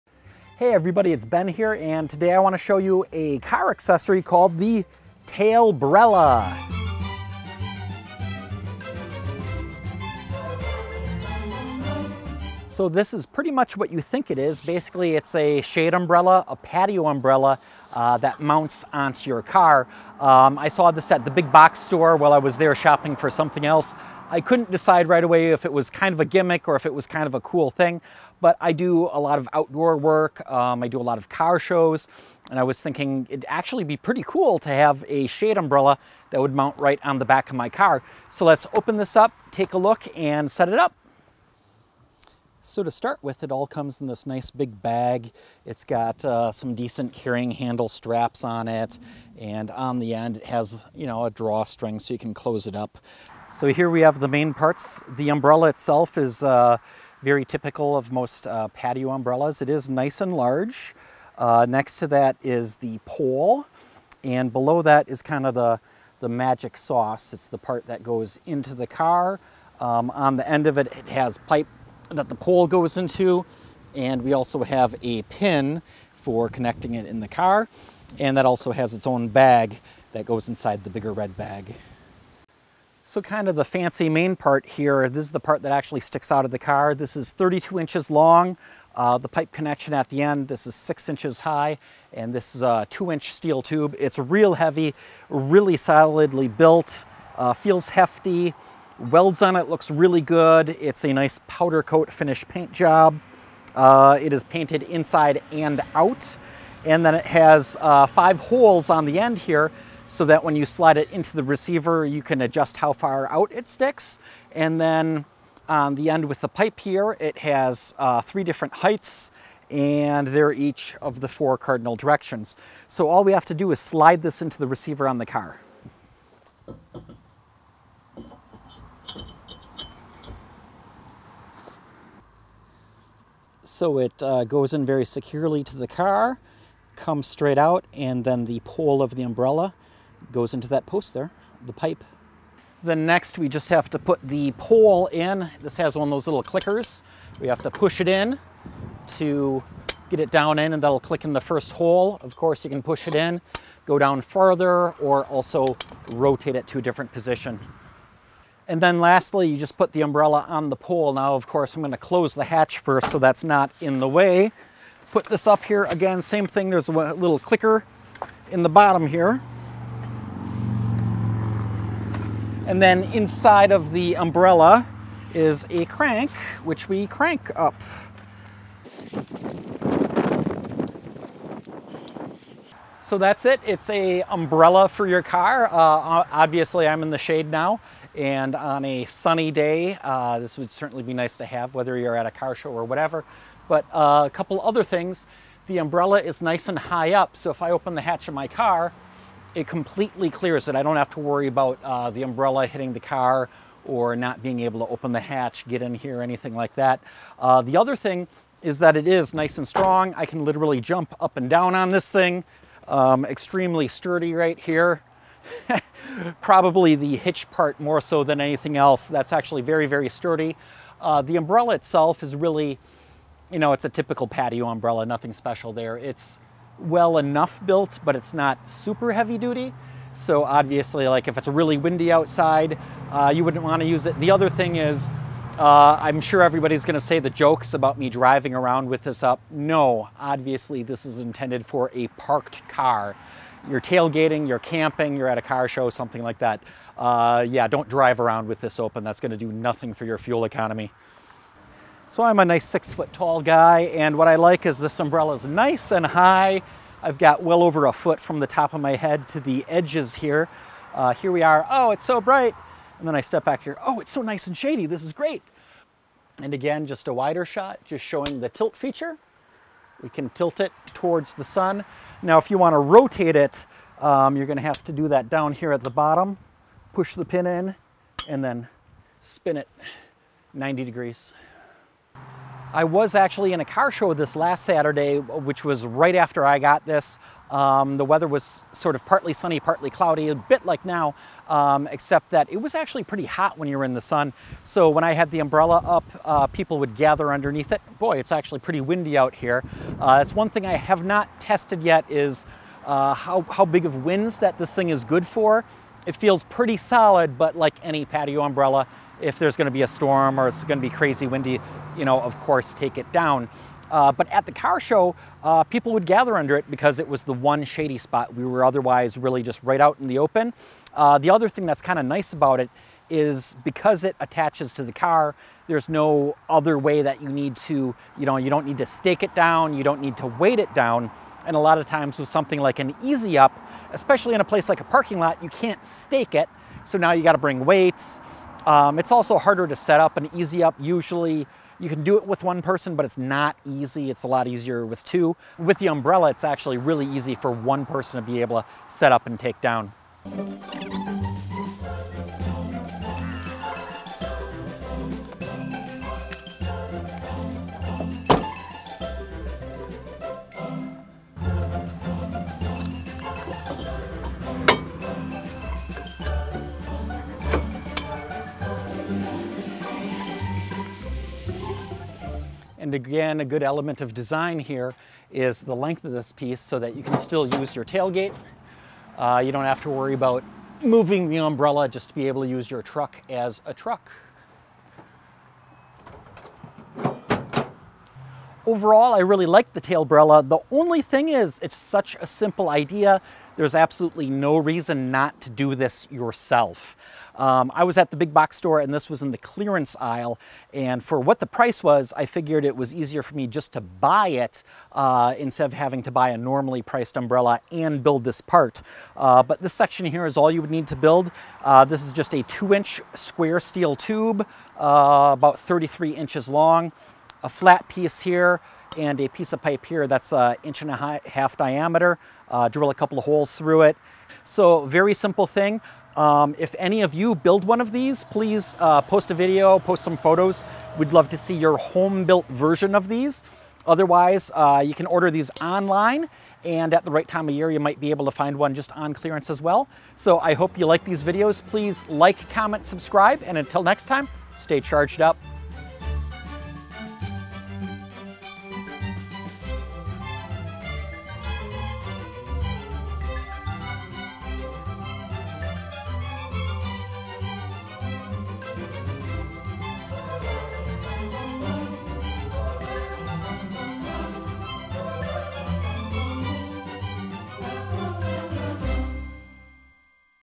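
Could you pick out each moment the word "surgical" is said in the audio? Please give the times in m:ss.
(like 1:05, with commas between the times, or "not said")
not said.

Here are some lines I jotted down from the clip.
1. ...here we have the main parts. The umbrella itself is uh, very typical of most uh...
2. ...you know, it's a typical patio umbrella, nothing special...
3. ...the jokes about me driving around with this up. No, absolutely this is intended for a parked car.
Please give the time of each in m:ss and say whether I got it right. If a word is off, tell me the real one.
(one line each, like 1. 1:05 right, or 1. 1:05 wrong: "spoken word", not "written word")
1. 0:53 right
2. 3:43 right
3. 3:57 wrong: "obviously", not "absolutely".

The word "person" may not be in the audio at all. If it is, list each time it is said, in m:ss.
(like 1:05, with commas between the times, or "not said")
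5:42, 5:47.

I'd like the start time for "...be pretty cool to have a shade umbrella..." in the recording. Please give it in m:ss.
0:33.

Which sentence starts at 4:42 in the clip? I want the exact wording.
I was actually in a car show this last Saturday, which was right after I got this.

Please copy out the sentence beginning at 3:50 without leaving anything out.
So obviously, like if it's really windy outside, uh, you wouldn't want to use it.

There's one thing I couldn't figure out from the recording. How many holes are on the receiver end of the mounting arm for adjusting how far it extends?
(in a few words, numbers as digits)
5.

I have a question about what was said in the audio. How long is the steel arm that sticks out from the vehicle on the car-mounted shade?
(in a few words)
32 inches.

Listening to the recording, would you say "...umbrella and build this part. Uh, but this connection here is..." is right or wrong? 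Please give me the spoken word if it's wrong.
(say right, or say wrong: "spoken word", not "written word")
wrong: "section", not "connection".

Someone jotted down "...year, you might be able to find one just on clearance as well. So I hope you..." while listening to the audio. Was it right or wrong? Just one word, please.
right.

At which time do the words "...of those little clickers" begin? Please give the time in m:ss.
2:26.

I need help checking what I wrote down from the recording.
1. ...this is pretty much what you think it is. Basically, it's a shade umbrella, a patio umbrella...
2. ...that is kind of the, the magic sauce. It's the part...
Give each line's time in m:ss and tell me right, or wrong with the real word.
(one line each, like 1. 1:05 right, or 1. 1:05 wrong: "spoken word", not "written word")
1. 0:12 right
2. 1:04 right.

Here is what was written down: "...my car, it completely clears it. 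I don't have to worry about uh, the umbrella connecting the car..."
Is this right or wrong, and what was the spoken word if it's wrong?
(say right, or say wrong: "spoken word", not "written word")
wrong: "hitting", not "connecting".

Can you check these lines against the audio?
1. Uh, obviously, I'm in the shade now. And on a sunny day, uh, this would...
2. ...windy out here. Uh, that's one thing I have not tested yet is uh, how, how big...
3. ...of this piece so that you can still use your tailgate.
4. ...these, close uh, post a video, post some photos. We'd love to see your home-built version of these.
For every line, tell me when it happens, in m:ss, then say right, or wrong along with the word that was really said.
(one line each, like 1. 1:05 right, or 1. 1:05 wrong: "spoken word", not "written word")
1. 3:05 right
2. 4:58 right
3. 6:16 right
4. 7:07 wrong: "please", not "close".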